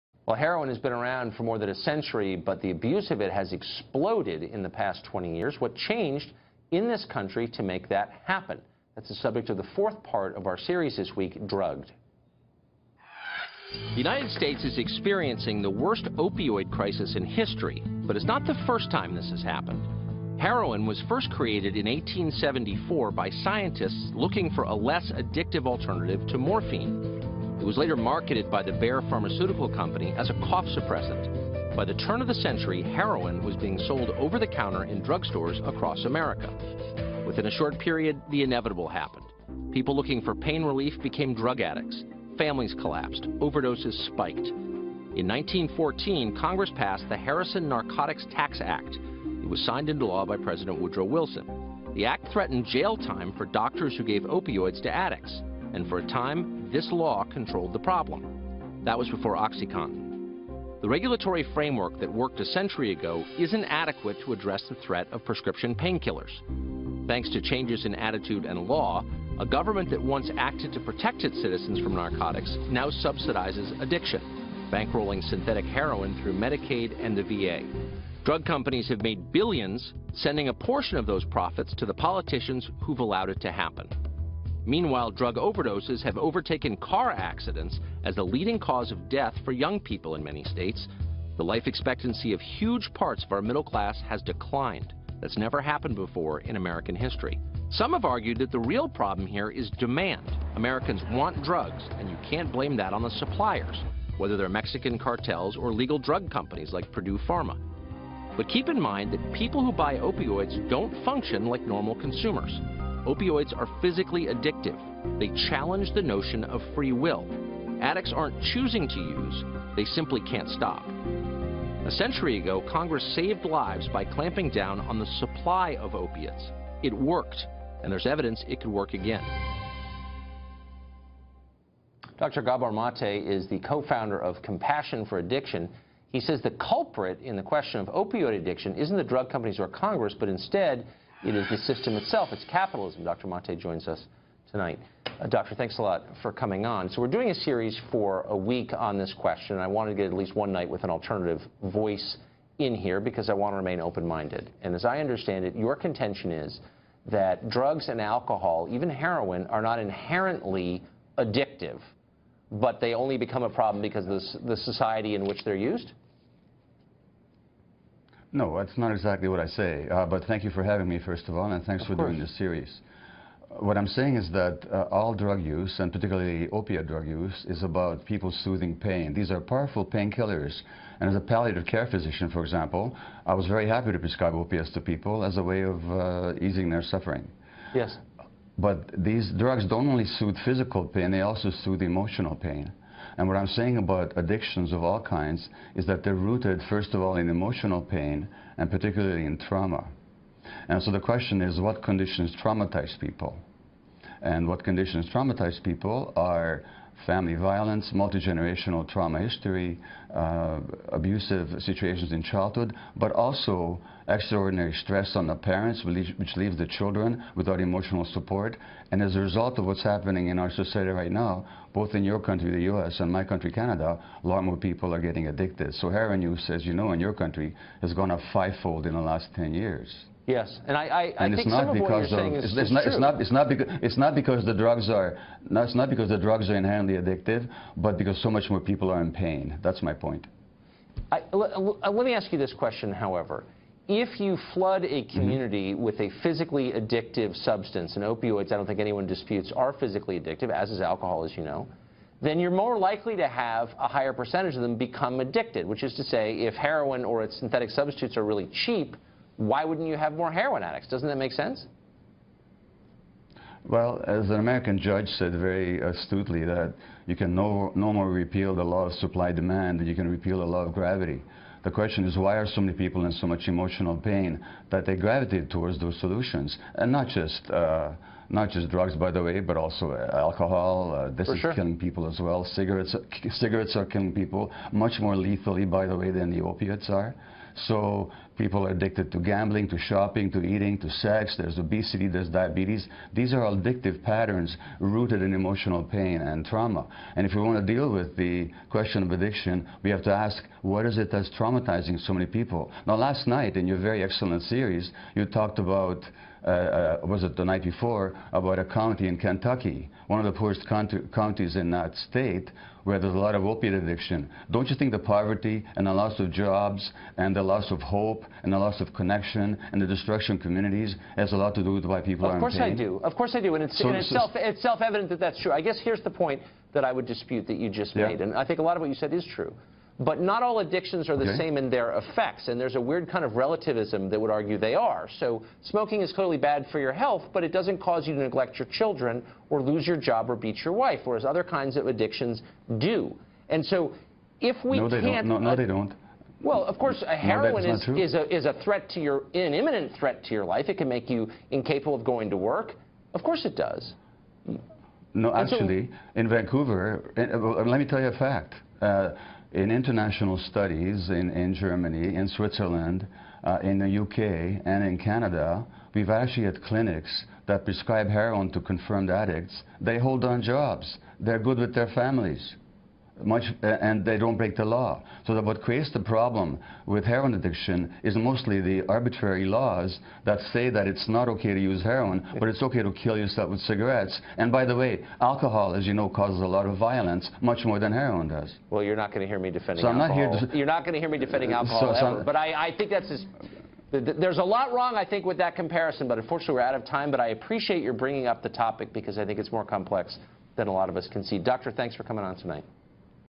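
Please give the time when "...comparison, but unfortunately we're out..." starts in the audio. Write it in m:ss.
6:35.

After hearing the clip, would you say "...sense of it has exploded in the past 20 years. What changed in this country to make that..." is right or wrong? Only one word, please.
wrong.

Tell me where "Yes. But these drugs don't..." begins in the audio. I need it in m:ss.
3:07.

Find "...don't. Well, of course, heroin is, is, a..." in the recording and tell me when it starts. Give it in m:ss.
5:45.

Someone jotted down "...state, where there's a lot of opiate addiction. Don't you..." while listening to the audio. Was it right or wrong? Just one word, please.
right.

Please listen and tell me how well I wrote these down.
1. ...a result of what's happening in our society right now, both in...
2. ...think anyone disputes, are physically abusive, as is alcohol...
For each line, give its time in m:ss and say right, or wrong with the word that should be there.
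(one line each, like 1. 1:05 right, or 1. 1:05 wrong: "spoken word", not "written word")
1. 3:39 right
2. 4:08 wrong: "addictive", not "abusive".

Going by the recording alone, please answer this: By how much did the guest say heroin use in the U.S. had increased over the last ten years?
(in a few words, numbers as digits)
fivefold.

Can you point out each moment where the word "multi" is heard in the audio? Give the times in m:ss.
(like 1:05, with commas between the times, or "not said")
3:27.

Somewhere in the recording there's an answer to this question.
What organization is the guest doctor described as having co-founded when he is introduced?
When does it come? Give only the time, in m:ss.
2:14.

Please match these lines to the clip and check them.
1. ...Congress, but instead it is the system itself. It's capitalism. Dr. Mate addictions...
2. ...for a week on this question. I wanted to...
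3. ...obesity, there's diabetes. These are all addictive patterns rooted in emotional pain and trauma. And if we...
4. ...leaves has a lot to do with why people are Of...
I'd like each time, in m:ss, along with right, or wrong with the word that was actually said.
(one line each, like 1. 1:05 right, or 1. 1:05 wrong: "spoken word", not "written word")
1. 2:19 wrong: "joins", not "addictions"
2. 2:27 right
3. 4:51 right
4. 5:20 wrong: "communities", not "leaves".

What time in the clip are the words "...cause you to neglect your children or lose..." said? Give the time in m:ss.
5:37.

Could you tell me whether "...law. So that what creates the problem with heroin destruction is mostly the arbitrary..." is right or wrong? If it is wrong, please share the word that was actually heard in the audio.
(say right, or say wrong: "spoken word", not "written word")
wrong: "addiction", not "destruction".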